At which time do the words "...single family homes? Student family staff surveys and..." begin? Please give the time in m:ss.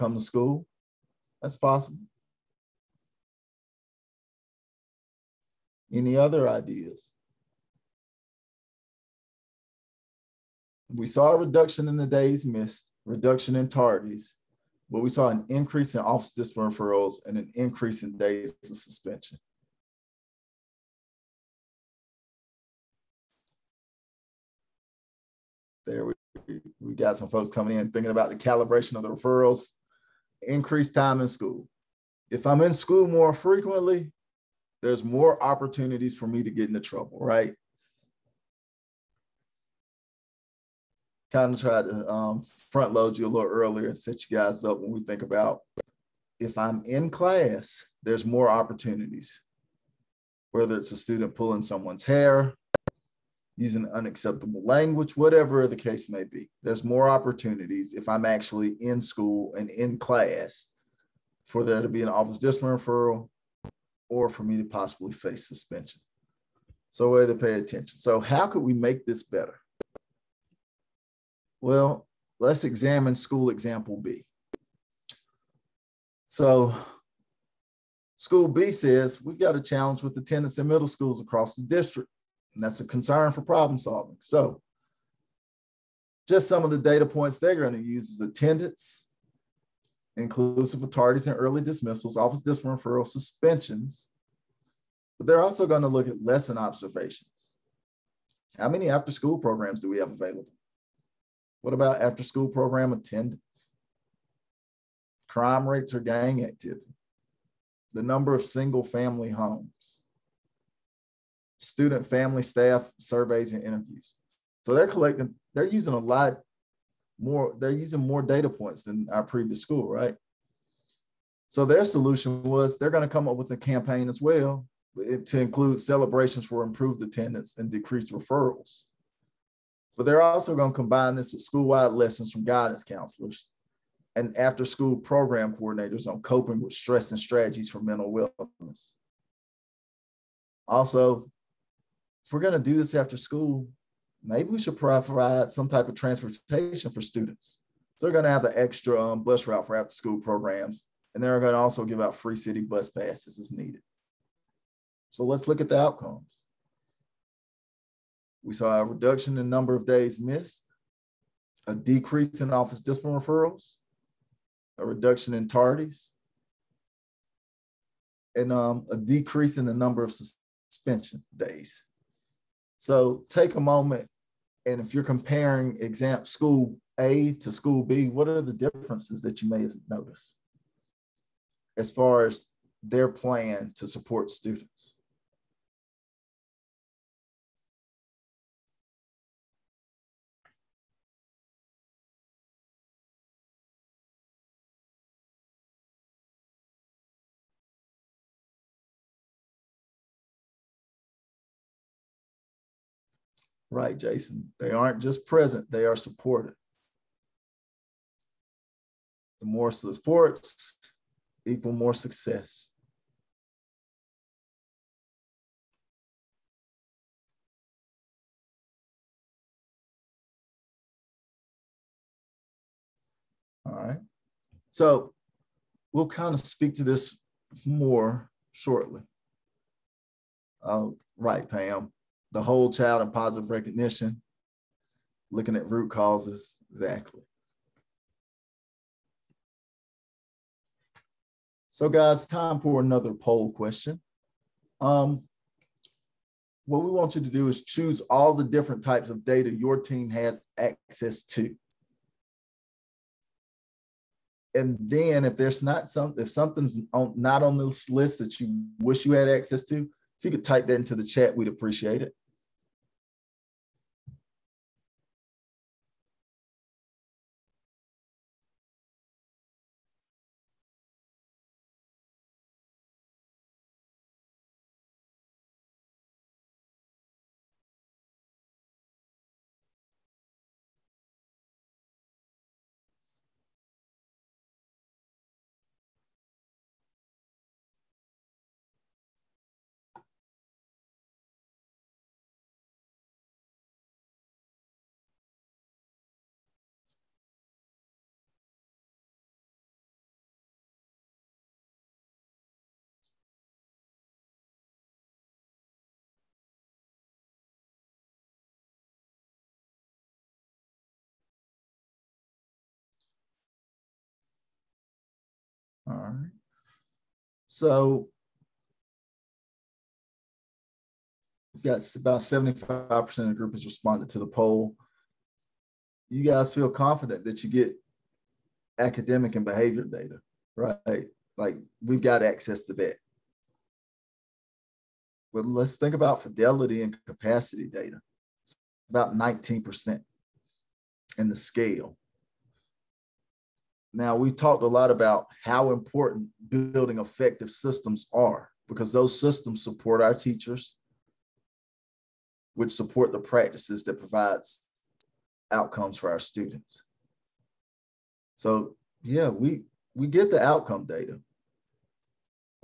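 1:48.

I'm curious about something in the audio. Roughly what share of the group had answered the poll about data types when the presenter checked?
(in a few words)
75%.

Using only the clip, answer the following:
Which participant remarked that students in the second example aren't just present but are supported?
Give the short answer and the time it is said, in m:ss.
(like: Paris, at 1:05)
Jason, at 3:23.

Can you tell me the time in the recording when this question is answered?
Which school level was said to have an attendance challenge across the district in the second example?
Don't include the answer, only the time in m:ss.
1:20.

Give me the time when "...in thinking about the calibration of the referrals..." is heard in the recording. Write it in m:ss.
0:27.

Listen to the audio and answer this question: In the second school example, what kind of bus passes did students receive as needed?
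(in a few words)
free city bus passes.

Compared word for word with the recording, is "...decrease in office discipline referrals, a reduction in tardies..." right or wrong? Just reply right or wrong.
right.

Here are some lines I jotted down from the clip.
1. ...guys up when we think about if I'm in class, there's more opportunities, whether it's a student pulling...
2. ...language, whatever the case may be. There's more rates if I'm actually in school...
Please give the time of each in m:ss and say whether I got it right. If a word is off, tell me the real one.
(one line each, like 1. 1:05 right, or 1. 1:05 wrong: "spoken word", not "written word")
1. 0:44 right
2. 0:54 wrong: "opportunities", not "rates".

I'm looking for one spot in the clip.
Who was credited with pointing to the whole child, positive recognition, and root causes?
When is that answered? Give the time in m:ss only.
3:51.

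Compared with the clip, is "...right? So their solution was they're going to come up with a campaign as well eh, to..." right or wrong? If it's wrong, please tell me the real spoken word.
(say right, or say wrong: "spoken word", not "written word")
right.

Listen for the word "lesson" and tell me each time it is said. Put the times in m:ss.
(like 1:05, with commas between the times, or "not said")
1:36, 2:11.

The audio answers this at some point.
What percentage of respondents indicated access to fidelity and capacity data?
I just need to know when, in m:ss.
5:39.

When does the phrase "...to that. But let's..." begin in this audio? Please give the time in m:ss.
5:32.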